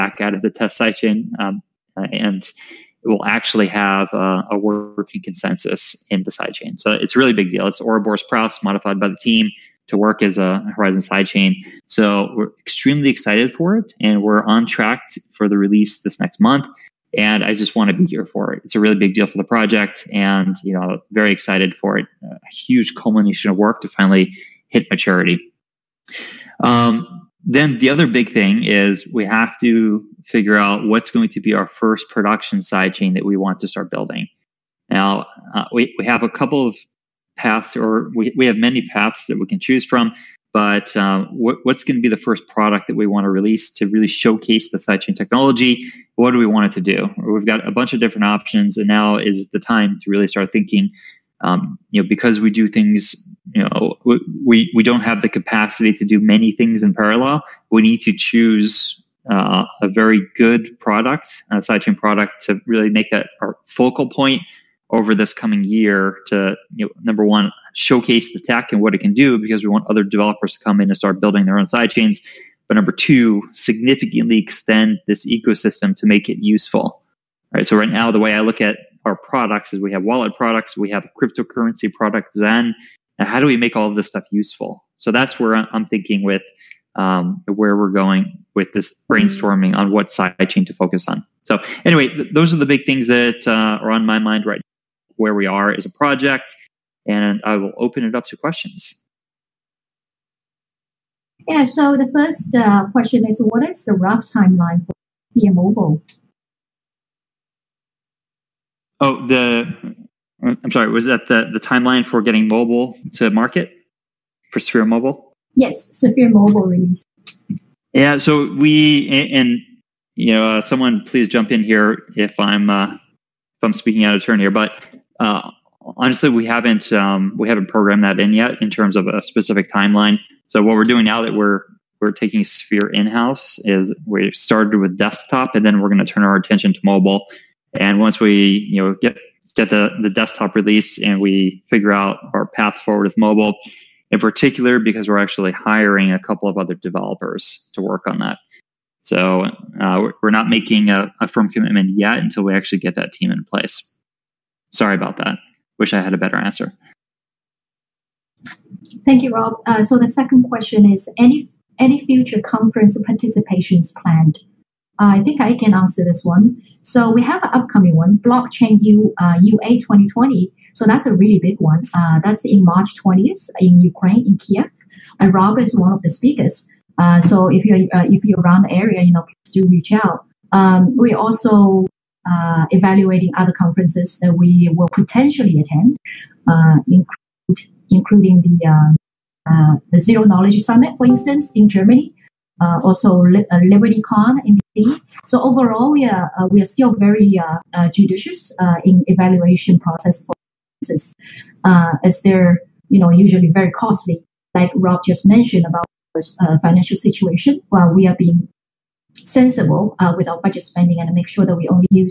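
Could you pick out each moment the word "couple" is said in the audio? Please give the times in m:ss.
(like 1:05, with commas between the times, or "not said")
0:36, 2:26.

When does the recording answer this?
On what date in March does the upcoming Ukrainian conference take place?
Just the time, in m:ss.
2:52.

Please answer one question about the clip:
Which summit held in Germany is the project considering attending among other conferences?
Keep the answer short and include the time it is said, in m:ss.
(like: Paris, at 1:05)
Zero Knowledge Summit, at 3:09.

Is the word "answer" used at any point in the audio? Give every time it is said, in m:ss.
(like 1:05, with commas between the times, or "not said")
2:36, 2:45.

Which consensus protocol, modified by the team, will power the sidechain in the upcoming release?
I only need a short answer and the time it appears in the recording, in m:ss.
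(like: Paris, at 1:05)
Ouroboros Praos, at 0:07.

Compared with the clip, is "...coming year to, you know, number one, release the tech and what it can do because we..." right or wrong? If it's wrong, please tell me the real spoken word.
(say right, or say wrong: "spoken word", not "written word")
wrong: "showcase", not "release".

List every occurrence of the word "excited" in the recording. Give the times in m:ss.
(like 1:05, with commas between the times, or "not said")
0:13, 0:21.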